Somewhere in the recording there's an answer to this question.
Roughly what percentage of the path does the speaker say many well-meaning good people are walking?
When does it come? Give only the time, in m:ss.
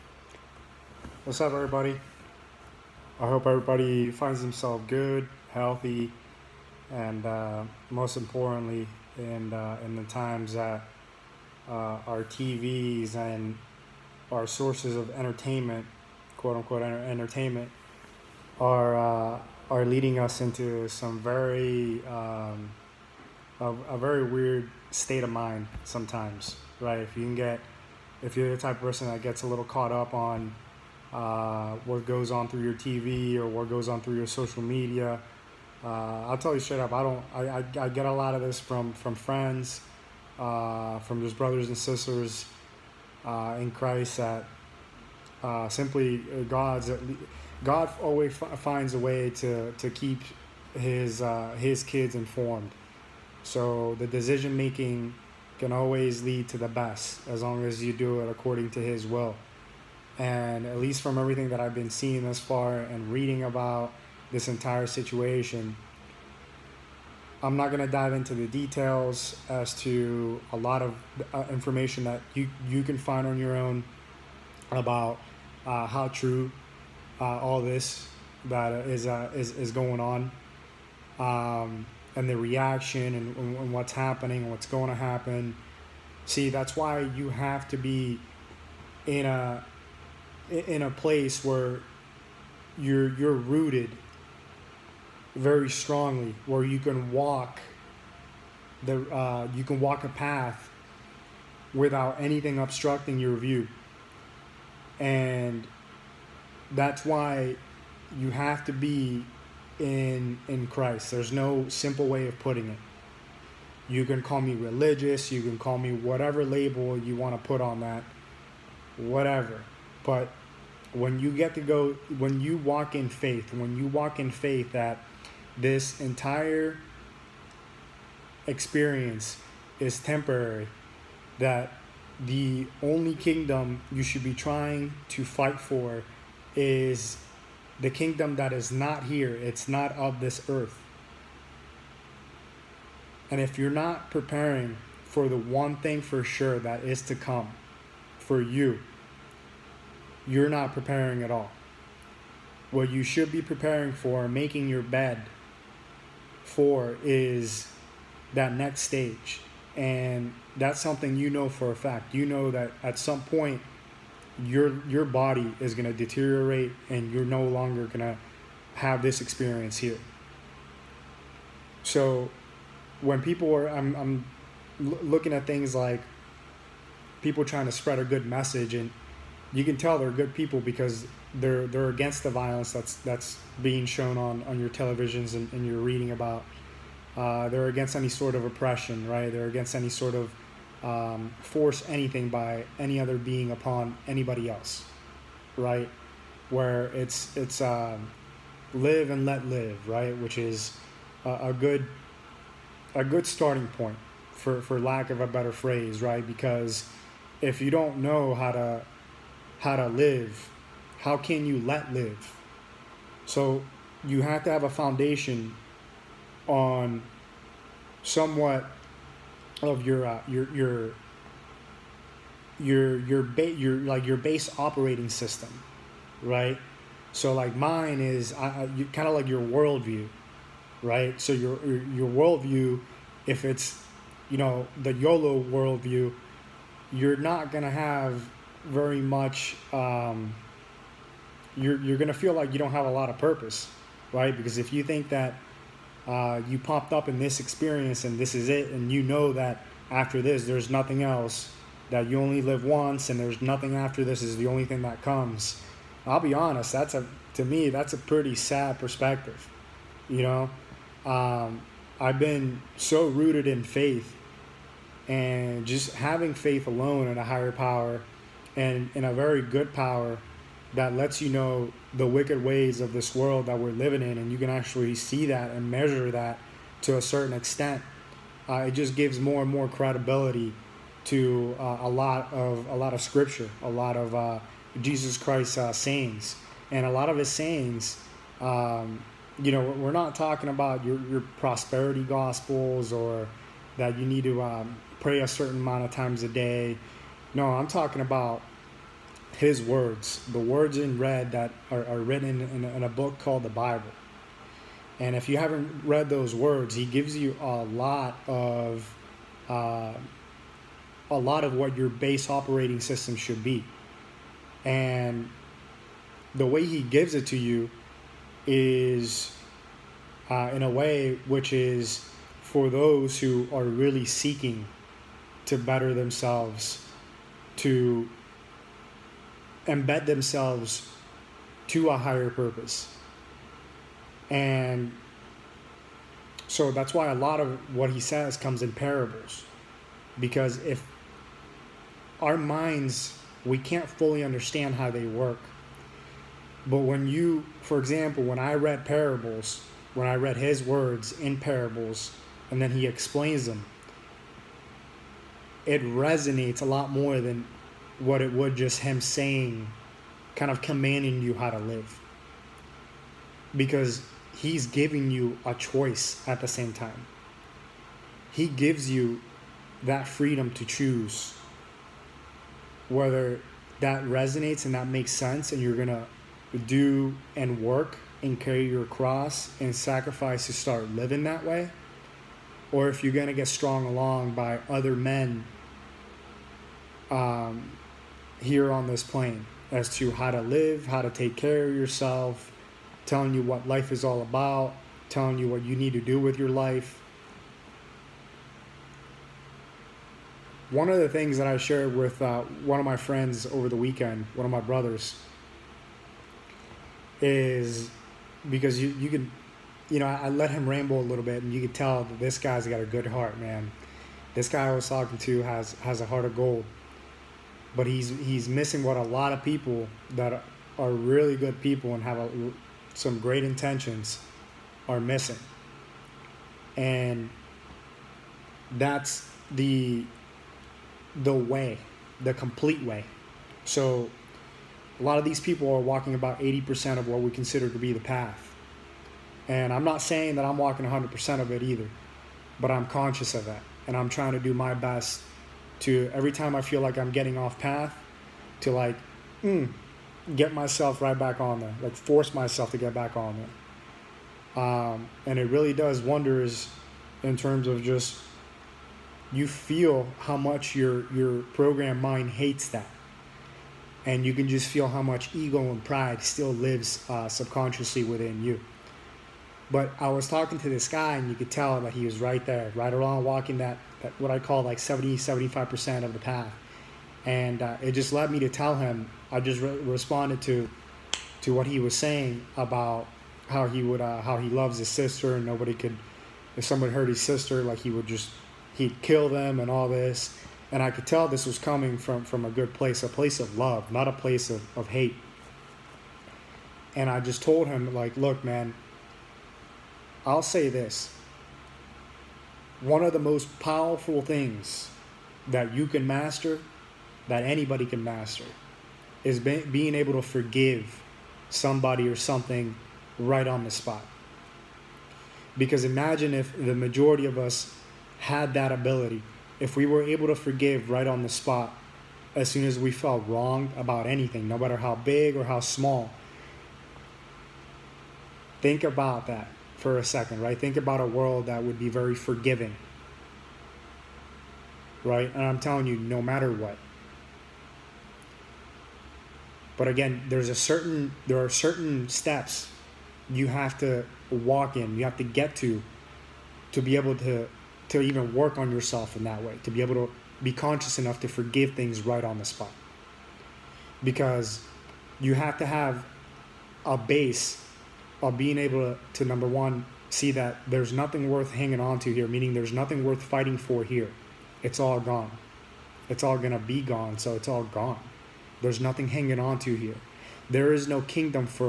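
7:16.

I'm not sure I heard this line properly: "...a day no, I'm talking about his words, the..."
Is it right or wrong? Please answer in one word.
right.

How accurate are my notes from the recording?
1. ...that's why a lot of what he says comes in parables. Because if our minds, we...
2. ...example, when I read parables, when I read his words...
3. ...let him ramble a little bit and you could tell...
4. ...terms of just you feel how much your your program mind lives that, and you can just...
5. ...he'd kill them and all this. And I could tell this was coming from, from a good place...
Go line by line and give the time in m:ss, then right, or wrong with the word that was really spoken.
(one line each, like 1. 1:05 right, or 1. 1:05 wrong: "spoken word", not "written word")
1. 5:36 right
2. 5:47 right
3. 6:50 right
4. 7:37 wrong: "hates", not "lives"
5. 8:08 right.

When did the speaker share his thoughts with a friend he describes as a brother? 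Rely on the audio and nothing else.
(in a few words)
Over the weekend.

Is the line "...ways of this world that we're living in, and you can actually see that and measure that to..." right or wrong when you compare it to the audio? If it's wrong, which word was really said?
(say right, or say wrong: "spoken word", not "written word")
right.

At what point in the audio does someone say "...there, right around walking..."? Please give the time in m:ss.
7:52.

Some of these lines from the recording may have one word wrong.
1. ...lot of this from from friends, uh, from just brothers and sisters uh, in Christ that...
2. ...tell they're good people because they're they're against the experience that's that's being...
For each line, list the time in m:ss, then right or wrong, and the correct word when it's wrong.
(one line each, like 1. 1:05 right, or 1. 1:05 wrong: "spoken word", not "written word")
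1. 0:38 right
2. 2:59 wrong: "violence", not "experience".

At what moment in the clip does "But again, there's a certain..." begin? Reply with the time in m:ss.
8:59.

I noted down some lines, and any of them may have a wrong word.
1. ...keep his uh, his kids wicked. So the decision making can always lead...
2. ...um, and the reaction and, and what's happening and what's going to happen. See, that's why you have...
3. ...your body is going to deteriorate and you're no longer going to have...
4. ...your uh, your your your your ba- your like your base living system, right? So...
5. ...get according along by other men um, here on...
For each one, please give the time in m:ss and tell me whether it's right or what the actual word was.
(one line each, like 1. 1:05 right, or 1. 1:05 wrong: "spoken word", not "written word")
1. 0:49 wrong: "informed", not "wicked"
2. 1:21 right
3. 2:44 right
4. 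3:39 wrong: "operating", not "living"
5. 6:23 wrong: "strong", not "according".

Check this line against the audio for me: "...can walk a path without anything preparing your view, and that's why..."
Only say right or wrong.
wrong.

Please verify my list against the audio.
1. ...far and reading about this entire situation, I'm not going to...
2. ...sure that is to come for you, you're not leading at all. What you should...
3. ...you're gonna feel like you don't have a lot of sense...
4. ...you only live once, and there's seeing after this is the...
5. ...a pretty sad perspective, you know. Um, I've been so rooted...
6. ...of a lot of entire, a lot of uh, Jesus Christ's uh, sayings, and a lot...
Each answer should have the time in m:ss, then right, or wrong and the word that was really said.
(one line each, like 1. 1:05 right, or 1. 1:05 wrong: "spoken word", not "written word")
1. 1:02 right
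2. 2:26 wrong: "preparing", not "leading"
3. 4:01 wrong: "purpose", not "sense"
4. 4:12 wrong: "nothing", not "seeing"
5. 4:17 right
6. 4:42 wrong: "scripture", not "entire".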